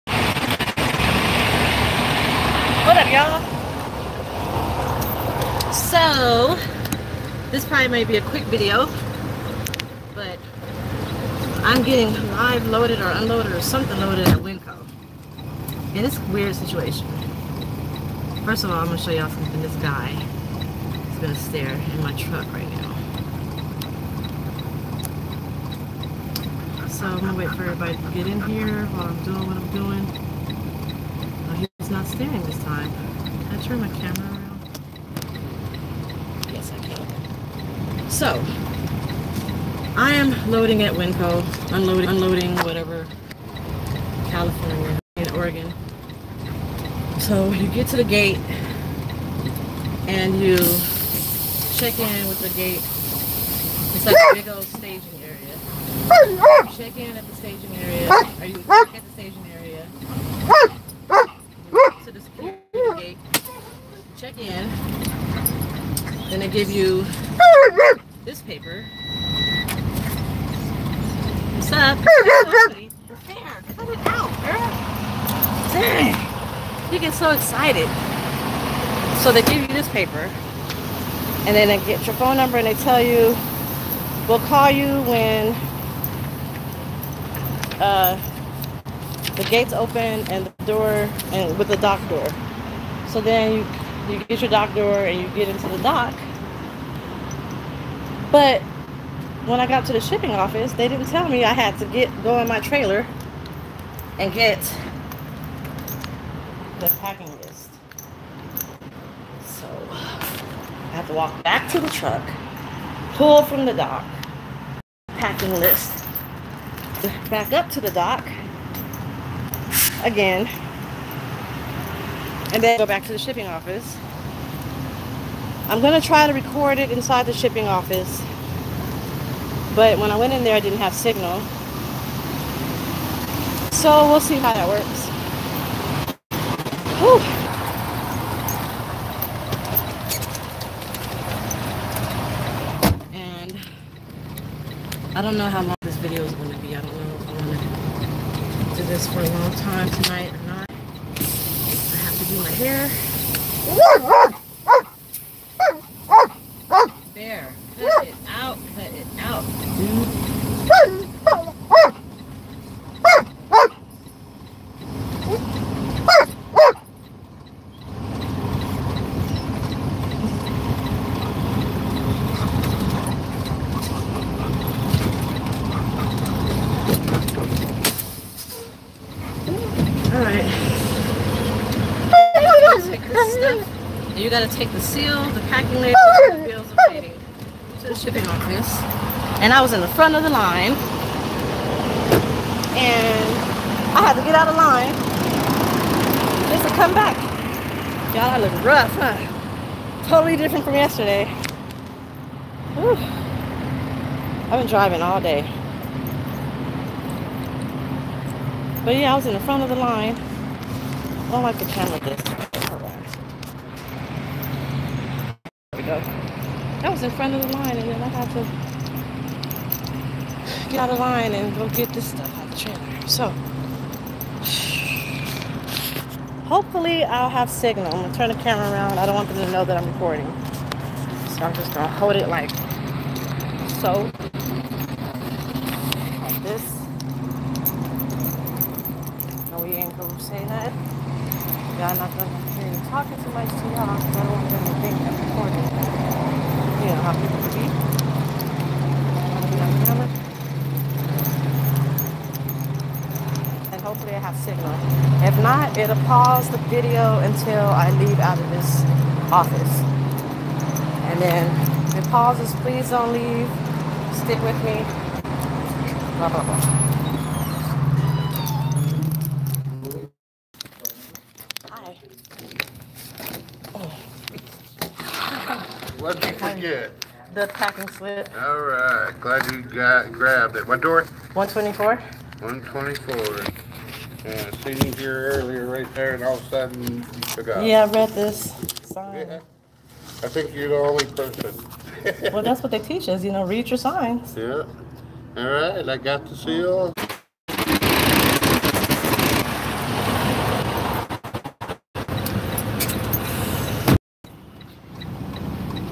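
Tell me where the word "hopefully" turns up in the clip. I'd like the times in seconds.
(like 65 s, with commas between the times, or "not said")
226 s, 253 s.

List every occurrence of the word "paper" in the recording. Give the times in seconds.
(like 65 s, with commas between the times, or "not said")
68 s, 79 s.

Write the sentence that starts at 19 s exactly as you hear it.
This guy is gonna stare in my truck right now.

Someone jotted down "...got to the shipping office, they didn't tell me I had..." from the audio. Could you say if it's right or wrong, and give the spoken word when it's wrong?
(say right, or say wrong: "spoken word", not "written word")
right.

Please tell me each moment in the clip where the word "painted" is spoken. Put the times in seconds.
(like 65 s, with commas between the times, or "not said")
not said.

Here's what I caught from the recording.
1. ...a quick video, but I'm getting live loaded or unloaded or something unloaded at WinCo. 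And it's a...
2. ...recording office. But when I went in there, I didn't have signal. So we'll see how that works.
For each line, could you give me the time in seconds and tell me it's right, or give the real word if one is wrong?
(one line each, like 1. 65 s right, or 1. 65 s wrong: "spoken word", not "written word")
1. 8 s wrong: "loaded", not "unloaded"
2. 127 s wrong: "shipping", not "recording".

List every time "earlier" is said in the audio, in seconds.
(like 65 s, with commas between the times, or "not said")
285 s.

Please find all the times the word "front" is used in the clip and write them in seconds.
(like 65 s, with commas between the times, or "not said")
189 s, 209 s, 217 s.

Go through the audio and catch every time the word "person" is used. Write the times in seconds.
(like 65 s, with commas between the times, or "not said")
291 s.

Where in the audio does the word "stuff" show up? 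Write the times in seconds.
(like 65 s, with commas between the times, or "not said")
222 s.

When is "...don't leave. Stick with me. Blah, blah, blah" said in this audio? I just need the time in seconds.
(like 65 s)
262 s.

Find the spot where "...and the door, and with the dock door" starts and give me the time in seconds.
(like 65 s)
90 s.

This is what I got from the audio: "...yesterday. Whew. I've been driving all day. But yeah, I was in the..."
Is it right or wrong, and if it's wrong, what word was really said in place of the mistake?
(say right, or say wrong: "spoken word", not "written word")
right.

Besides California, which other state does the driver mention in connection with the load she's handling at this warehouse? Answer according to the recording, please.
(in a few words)
Oregon.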